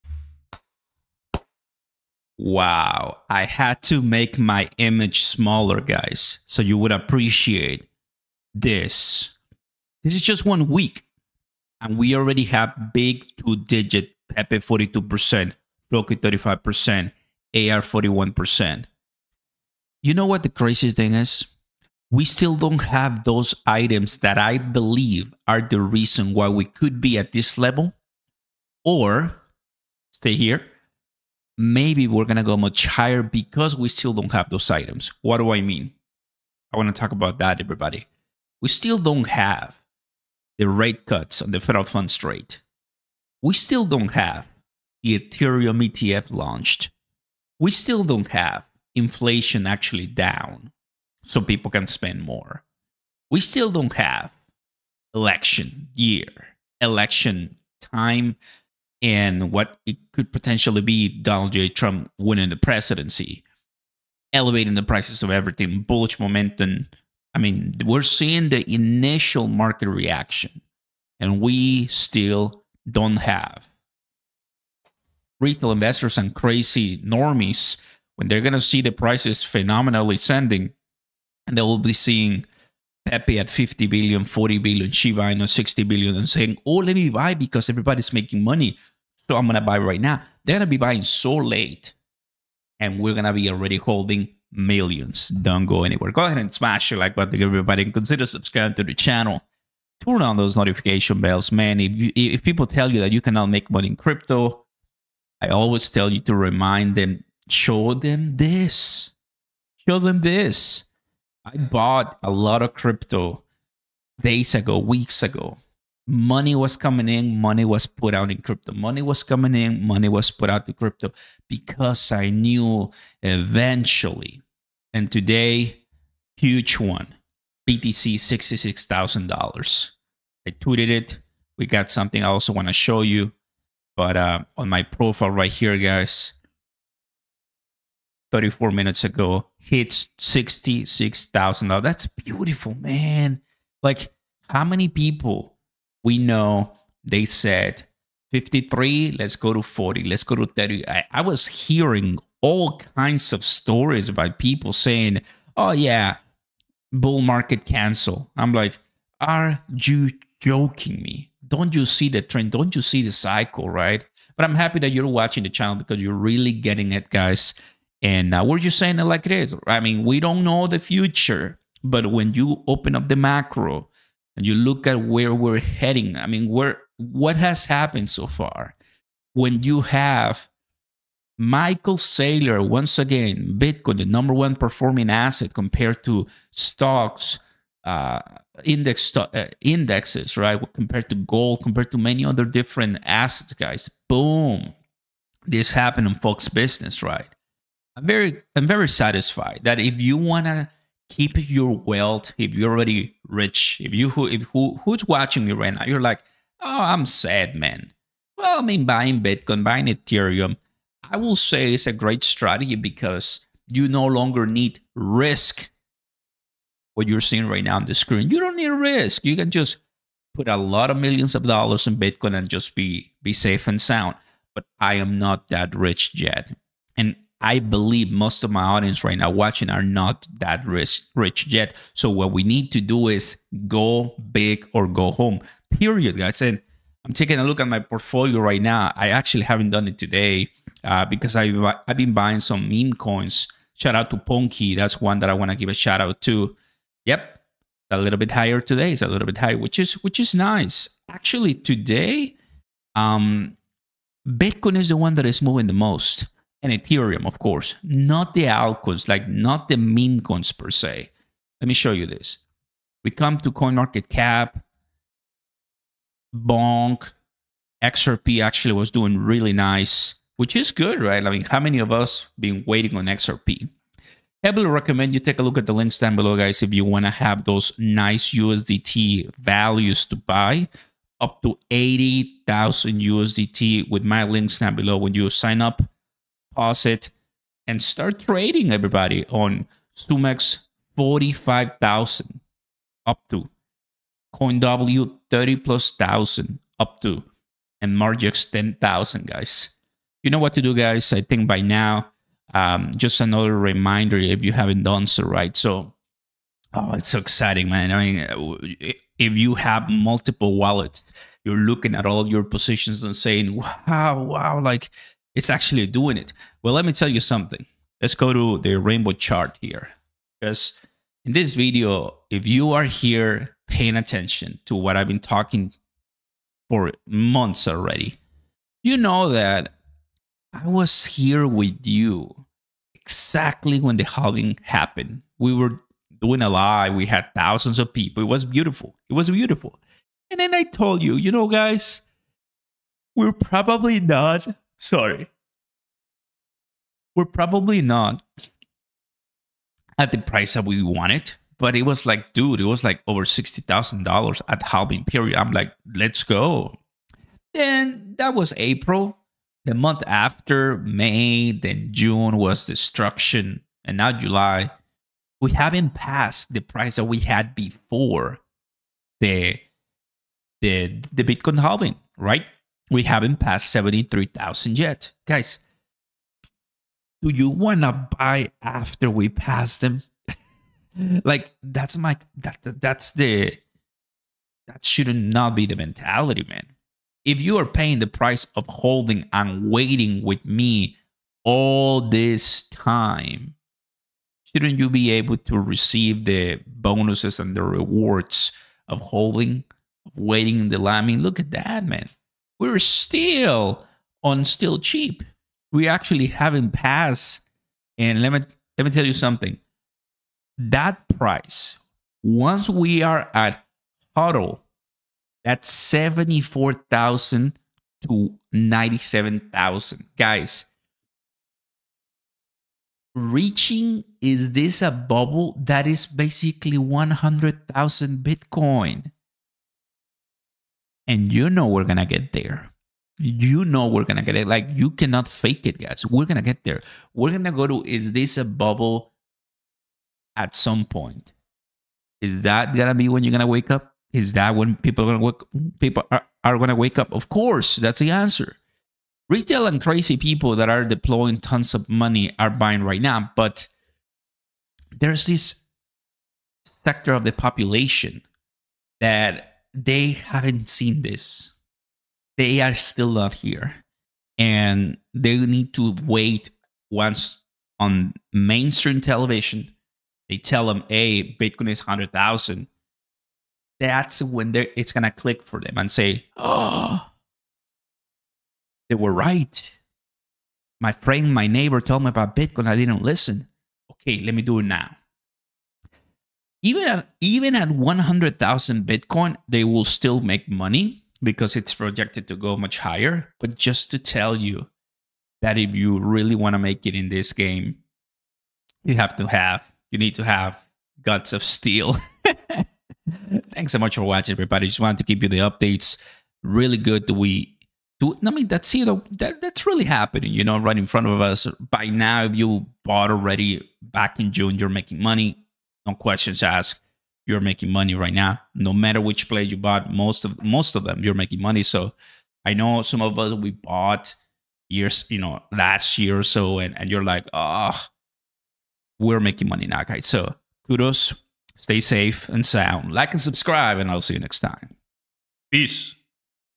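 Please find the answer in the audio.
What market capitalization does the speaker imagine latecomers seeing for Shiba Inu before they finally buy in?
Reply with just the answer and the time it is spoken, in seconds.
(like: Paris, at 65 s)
60 billion, at 84 s.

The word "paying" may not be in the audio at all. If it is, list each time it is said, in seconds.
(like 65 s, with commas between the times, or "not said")
323 s, 387 s.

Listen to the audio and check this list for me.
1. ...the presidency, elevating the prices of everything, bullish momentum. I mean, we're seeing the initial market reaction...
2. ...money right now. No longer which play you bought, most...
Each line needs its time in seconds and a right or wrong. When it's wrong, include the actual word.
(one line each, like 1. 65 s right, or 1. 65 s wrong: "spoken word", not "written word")
1. 62 s right
2. 517 s wrong: "matter", not "longer".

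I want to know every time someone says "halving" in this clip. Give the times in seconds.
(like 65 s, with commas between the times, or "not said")
334 s, 354 s, 371 s.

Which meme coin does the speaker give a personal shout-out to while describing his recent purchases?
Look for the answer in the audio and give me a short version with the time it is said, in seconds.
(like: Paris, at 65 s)
Ponky, at 244 s.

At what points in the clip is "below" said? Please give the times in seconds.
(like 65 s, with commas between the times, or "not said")
276 s, 284 s.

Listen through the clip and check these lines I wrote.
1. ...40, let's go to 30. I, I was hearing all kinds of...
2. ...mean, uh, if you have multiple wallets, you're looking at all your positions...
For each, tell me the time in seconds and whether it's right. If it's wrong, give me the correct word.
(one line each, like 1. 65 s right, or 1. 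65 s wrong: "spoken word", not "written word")
1. 149 s right
2. 308 s right.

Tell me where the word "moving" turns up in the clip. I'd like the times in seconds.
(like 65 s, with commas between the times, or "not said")
255 s.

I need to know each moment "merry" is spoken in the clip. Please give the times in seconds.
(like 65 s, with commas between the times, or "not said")
not said.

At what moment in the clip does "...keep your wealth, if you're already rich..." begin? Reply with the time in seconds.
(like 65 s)
201 s.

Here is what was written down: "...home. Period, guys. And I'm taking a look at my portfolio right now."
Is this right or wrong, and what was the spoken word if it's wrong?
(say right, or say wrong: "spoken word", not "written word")
right.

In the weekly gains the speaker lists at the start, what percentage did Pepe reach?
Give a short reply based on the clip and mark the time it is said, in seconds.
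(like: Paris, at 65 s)
42%, at 14 s.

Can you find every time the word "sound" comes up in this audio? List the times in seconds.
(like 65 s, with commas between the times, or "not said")
223 s, 532 s.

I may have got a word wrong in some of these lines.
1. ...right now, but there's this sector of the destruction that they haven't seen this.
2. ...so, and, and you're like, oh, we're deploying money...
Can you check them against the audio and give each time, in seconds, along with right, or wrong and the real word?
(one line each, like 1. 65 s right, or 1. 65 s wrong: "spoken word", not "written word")
1. 452 s wrong: "population", not "destruction"
2. 526 s wrong: "making", not "deploying".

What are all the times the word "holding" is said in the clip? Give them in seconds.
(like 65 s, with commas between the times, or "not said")
93 s, 388 s, 398 s.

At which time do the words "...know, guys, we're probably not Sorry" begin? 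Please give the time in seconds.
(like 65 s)
341 s.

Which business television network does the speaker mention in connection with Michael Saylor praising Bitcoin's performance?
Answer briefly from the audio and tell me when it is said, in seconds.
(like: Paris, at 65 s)
Fox Business, at 196 s.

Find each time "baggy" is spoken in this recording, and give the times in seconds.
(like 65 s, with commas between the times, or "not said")
not said.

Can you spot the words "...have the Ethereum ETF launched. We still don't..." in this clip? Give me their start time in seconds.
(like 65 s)
44 s.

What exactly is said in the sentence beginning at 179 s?
When you have Michael Saylor, once again, Bitcoin, the number one performing asset compared to stocks, uh, index uh, indexes, right?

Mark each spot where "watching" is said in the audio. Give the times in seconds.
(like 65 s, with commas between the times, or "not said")
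165 s, 205 s, 229 s, 504 s.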